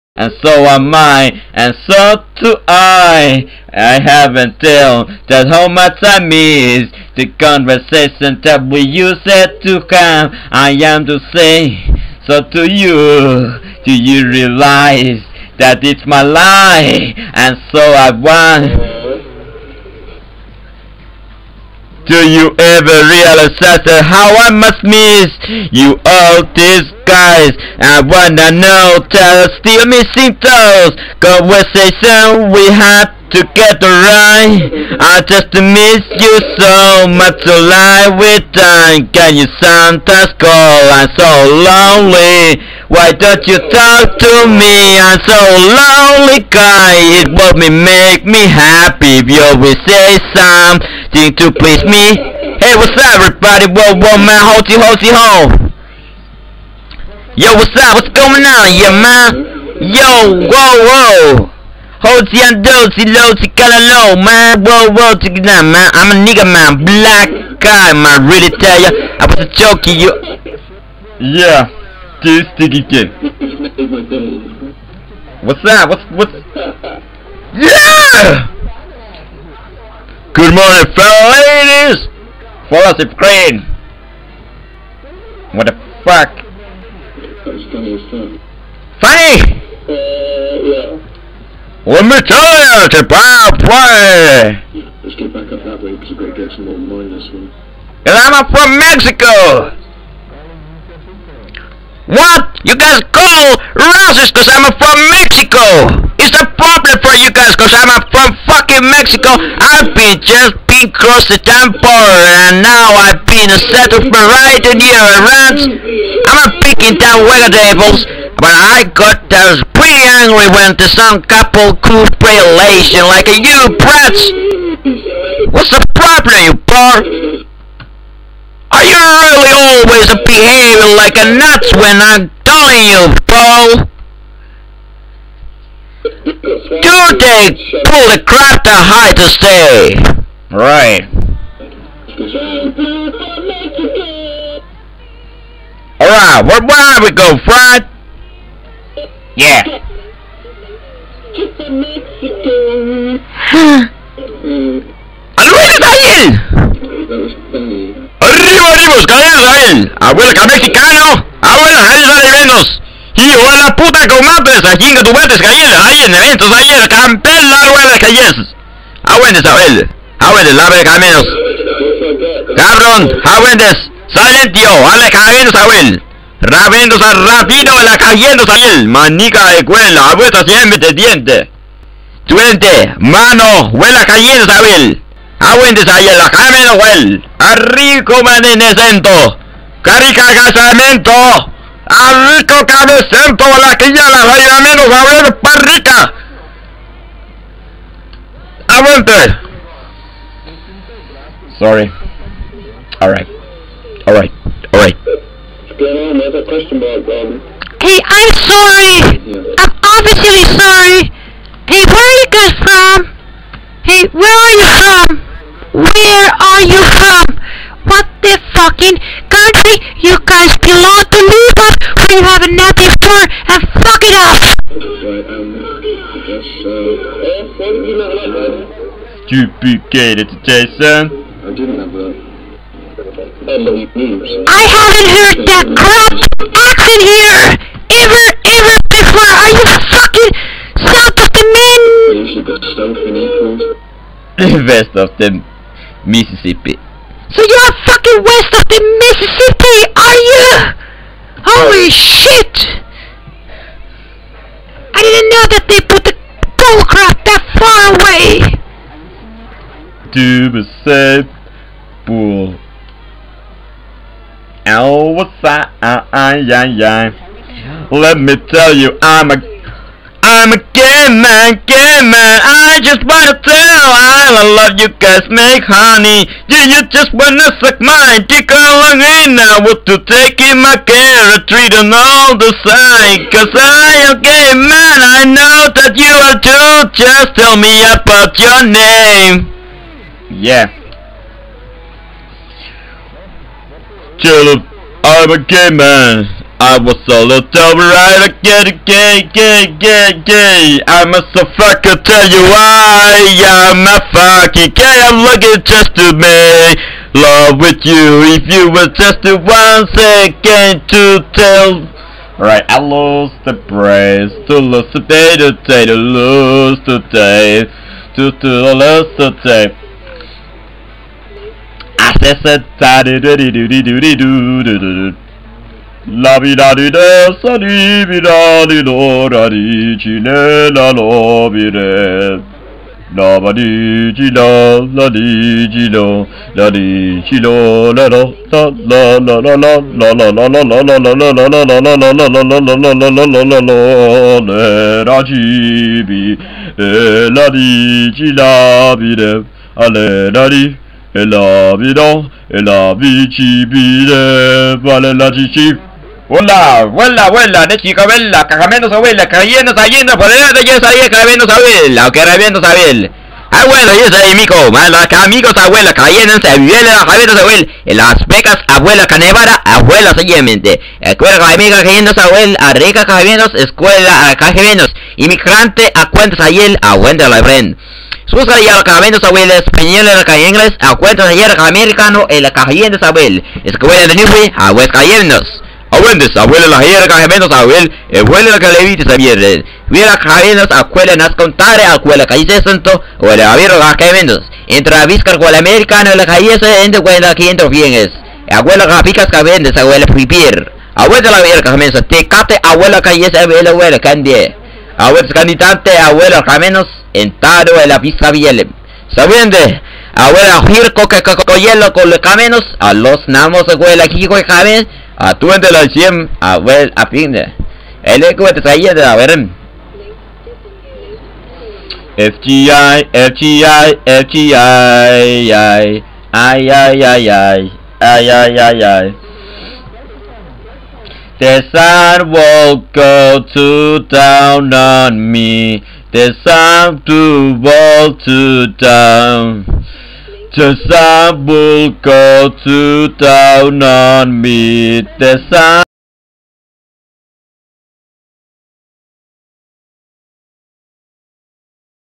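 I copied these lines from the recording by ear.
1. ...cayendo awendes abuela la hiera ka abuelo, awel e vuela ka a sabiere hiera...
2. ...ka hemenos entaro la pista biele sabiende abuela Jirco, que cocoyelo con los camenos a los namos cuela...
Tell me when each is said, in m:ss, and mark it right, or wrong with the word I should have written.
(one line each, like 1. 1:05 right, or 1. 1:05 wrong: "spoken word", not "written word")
1. 6:24 wrong: "viera", not "hiera"
2. 6:46 wrong: "abuela", not "cuela".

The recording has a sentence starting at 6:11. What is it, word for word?
Escuela, amiga, cayendo, abuela, arriba, cagamenos, escuela, cagamenos, inmigrante, a cuentas, ayer, a cuentas, la friend.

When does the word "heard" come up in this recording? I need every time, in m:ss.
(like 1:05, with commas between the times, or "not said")
3:55.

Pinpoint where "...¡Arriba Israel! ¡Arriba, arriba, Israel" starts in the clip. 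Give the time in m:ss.
2:35.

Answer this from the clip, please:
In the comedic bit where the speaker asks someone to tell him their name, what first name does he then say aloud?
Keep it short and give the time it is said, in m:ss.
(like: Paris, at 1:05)
Caleb, at 4:54.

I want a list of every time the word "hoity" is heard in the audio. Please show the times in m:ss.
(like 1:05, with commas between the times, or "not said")
0:54, 1:02.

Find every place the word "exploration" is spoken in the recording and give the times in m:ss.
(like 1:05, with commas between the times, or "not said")
not said.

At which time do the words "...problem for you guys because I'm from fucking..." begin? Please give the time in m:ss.
1:46.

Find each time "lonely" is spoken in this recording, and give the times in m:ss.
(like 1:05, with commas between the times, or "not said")
0:41, 0:45.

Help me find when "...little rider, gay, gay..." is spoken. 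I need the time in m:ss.
4:57.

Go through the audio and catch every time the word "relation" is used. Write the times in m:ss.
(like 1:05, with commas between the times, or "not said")
2:02.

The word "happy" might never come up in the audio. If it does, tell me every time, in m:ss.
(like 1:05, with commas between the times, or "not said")
0:48.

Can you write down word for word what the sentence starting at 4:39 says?
I want to take in my care, treat on all the side.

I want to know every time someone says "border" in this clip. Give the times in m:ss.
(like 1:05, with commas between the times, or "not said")
1:51.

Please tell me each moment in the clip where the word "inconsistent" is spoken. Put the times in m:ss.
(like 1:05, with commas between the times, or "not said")
not said.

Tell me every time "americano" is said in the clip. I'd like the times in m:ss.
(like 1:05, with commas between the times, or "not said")
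6:21, 6:35.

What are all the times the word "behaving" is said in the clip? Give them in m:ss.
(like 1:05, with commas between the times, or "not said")
2:10.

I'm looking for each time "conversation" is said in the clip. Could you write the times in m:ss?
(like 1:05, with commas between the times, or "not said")
0:07, 0:31.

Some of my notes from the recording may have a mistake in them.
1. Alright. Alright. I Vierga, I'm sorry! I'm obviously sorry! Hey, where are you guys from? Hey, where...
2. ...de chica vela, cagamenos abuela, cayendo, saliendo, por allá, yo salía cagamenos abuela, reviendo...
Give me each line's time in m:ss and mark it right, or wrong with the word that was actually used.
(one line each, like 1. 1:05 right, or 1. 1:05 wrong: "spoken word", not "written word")
1. 3:24 wrong: "Hey", not "Vierga"
2. 5:57 right.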